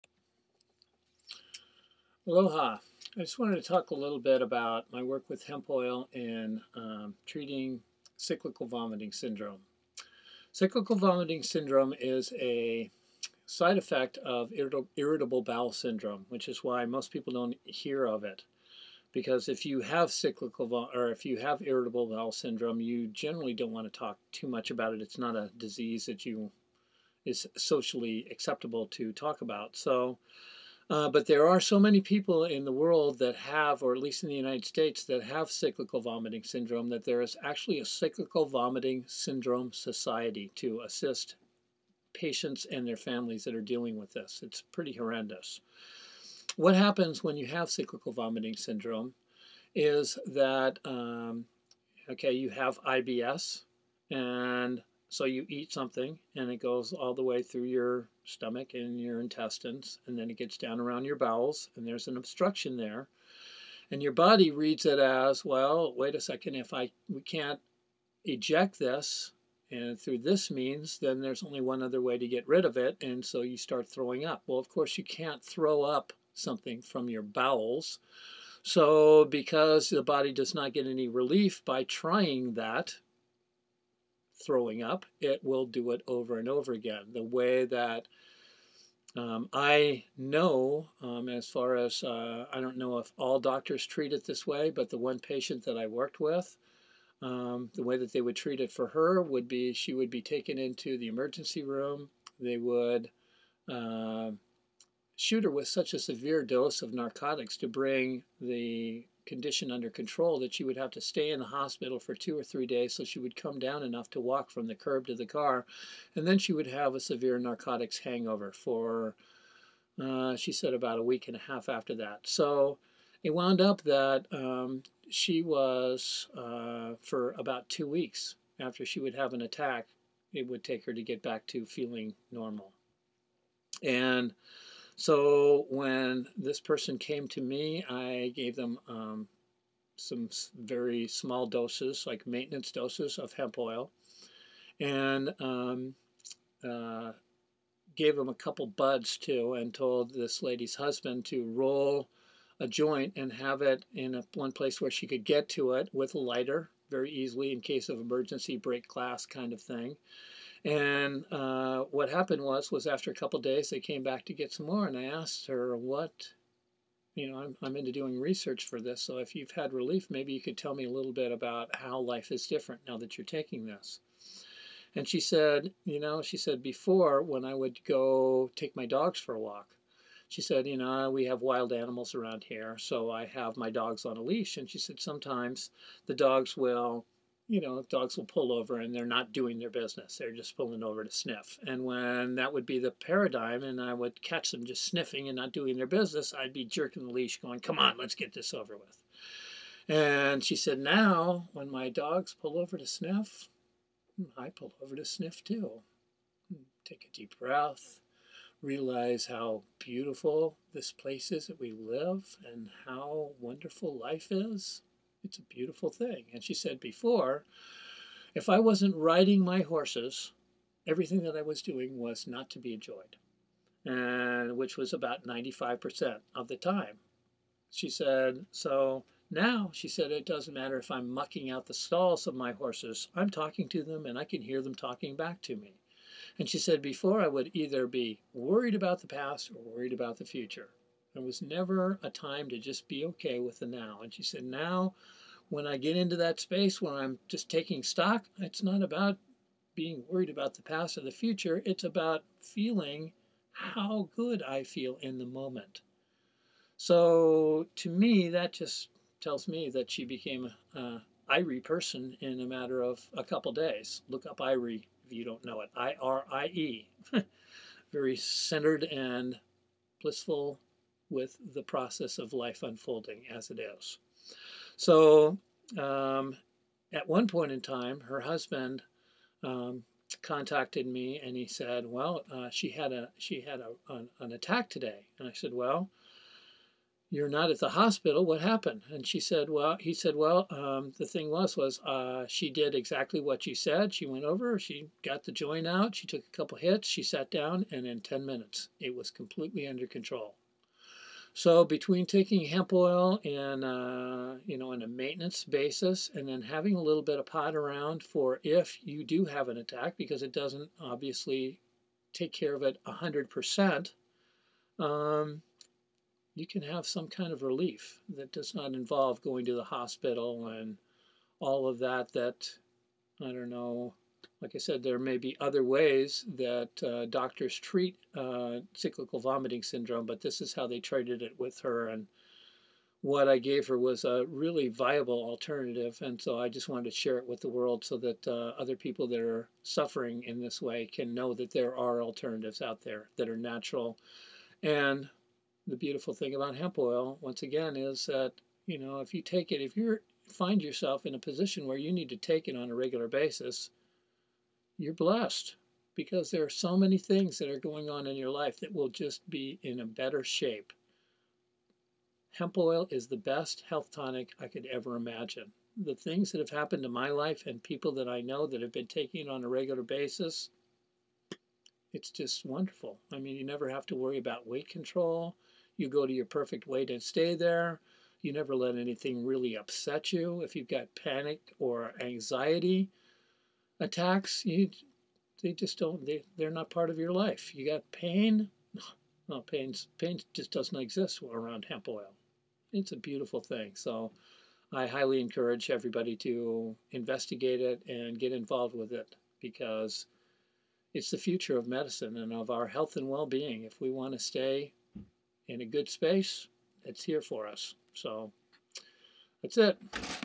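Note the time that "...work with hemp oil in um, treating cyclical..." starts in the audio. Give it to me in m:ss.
0:05.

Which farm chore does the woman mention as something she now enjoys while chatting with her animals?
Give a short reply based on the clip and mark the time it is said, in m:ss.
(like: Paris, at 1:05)
mucking out the stalls, at 3:51.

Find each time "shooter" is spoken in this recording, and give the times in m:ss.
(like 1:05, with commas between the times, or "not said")
1:45.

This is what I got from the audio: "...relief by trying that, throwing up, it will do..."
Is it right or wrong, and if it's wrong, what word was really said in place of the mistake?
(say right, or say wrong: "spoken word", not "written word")
right.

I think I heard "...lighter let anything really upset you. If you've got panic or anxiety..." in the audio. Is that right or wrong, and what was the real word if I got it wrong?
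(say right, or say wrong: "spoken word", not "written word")
wrong: "never", not "lighter".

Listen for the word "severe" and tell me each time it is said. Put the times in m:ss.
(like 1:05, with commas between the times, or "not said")
1:45, 1:56.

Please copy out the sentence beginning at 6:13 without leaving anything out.
I mean, you never have to worry about weight control.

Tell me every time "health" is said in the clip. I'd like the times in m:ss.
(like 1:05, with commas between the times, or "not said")
6:03, 6:42.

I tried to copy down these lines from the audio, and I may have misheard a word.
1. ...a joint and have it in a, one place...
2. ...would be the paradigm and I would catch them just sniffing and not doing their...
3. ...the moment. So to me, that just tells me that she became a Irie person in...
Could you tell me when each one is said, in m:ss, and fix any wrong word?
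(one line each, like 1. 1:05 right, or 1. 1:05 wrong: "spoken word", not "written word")
1. 2:32 right
2. 3:12 right
3. 4:15 right.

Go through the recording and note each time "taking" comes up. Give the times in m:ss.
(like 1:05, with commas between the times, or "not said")
2:53, 4:07, 5:02, 6:08.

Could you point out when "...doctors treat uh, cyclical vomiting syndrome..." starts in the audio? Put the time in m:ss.
5:27.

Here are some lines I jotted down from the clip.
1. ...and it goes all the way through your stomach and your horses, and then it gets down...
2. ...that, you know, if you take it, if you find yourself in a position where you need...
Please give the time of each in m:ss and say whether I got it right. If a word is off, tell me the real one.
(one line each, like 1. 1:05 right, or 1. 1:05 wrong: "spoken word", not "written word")
1. 0:56 wrong: "intestines", not "horses"
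2. 5:48 right.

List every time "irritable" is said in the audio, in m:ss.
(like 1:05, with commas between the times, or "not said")
0:14, 0:21.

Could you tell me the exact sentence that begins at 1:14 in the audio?
Well, of course, you can't throw up something from your bowels.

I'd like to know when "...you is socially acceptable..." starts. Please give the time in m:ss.
0:26.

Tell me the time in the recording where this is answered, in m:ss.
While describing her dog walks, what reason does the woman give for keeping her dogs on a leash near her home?
3:01.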